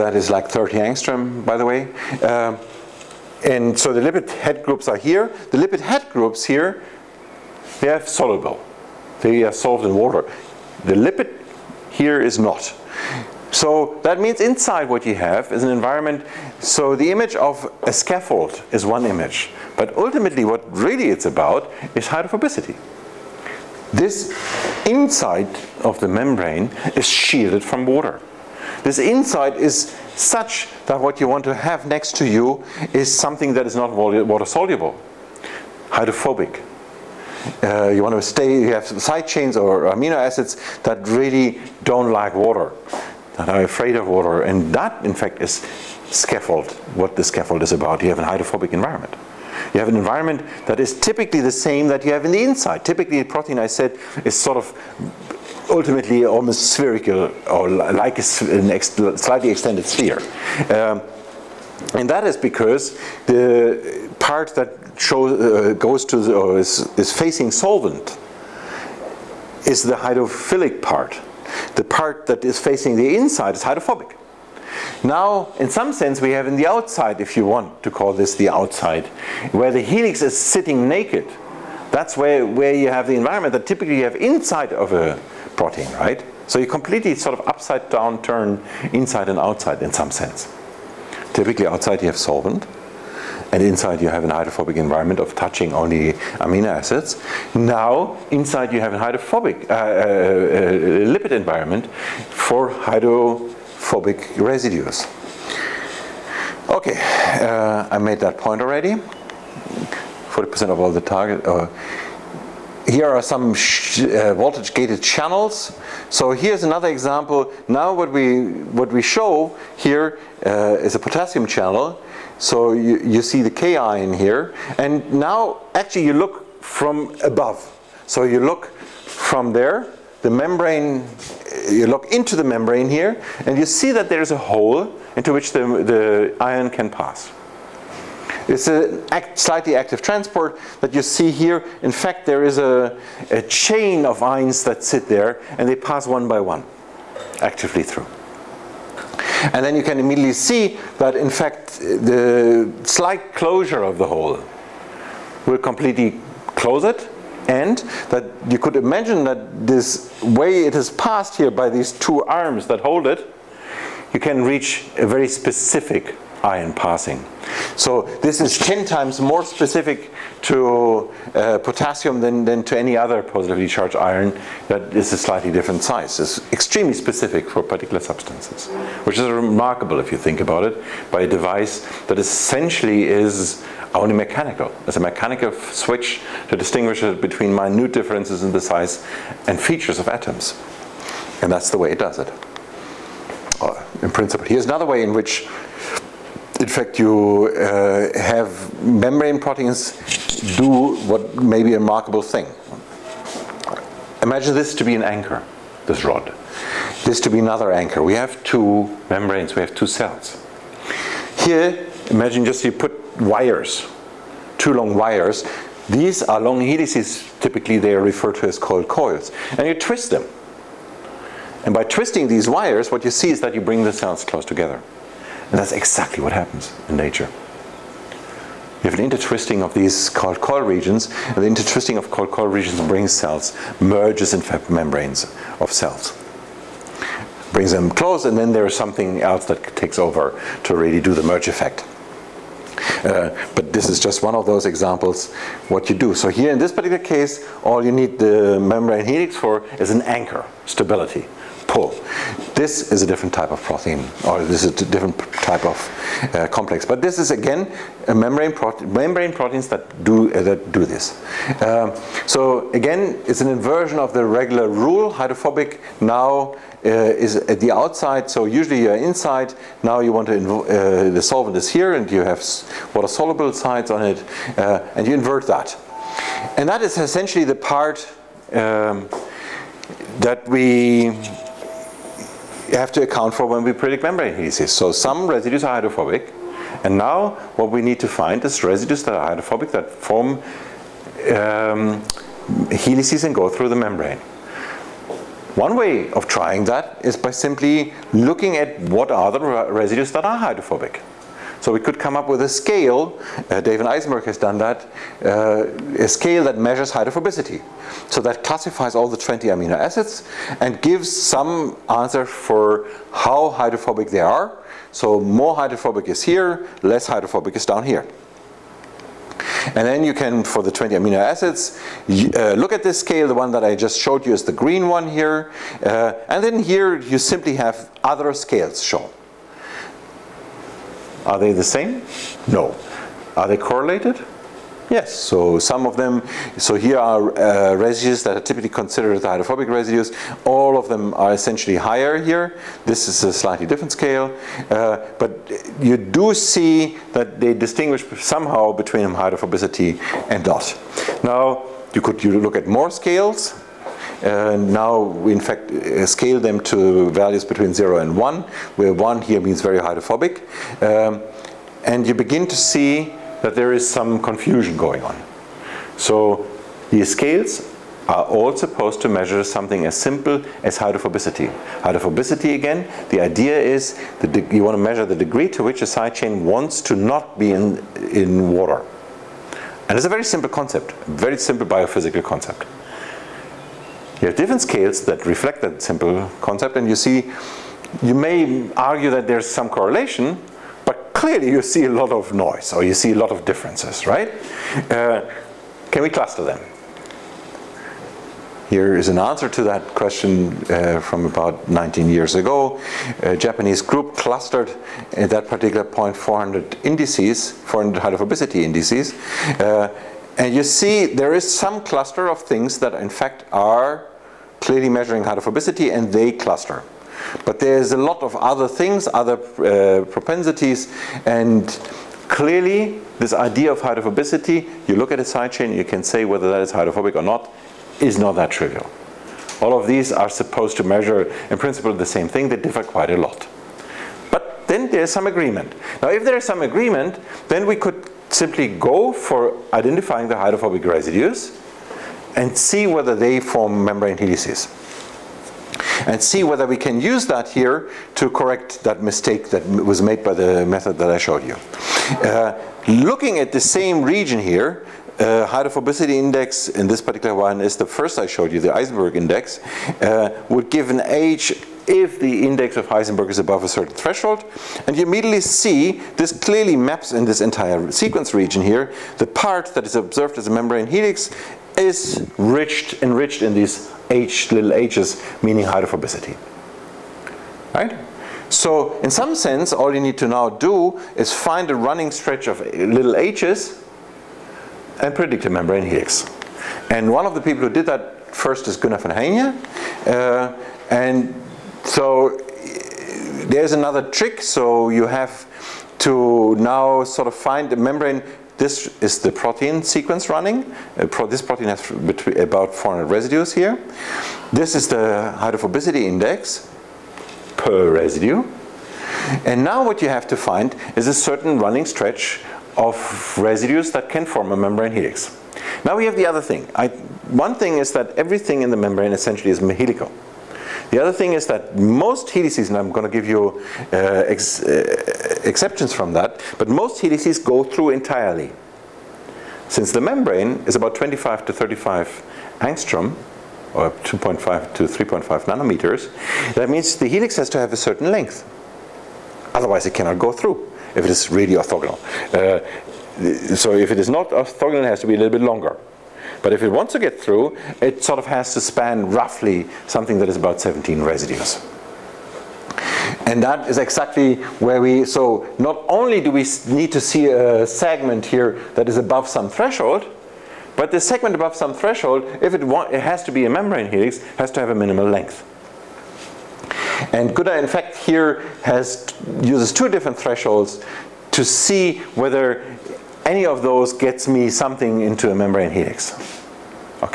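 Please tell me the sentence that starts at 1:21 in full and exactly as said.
That's where, where you have the environment that typically you have inside of a protein, right?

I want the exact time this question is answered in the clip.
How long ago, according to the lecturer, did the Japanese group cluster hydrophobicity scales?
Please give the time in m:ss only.
6:41.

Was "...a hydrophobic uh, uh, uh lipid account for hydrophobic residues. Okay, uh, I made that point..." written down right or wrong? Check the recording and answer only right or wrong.
wrong.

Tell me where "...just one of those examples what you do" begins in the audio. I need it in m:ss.
4:03.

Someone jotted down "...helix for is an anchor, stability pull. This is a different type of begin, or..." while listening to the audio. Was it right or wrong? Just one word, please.
wrong.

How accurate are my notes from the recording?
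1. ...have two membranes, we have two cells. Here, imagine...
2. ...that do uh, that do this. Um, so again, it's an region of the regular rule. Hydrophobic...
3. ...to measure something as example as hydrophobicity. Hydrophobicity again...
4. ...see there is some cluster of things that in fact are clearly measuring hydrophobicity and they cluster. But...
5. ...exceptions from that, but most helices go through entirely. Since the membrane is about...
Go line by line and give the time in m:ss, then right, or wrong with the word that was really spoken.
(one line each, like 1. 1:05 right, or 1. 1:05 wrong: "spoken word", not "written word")
1. 3:28 right
2. 4:19 wrong: "inversion", not "region"
3. 6:09 wrong: "simple", not "example"
4. 6:50 right
5. 8:45 right.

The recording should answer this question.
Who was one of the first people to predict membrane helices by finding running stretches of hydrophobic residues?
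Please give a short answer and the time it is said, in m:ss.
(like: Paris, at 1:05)
Gunnar von Heijne, at 8:08.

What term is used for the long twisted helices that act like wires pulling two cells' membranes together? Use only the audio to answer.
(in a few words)
Coiled coils.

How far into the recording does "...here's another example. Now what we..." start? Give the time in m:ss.
1:56.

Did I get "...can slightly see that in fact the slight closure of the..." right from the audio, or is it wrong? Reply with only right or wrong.
wrong.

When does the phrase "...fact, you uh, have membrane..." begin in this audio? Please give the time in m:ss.
3:16.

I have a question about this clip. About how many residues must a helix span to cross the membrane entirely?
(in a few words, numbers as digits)
17.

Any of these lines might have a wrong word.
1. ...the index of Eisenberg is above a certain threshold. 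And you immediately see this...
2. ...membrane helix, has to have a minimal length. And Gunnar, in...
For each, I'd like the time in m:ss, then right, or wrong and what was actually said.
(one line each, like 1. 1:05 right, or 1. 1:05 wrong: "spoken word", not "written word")
1. 7:42 right
2. 9:23 right.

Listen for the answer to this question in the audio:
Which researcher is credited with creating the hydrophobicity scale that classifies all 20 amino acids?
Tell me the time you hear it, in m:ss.
5:03.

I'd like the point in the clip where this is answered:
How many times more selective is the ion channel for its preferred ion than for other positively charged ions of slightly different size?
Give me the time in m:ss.
2:48.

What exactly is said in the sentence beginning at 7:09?
All of these are supposed to measure in principle the same thing, they differ quite a lot.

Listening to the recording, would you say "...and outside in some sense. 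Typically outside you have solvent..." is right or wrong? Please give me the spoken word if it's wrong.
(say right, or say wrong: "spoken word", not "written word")
right.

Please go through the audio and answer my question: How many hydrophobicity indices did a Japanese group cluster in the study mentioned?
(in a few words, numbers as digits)
400.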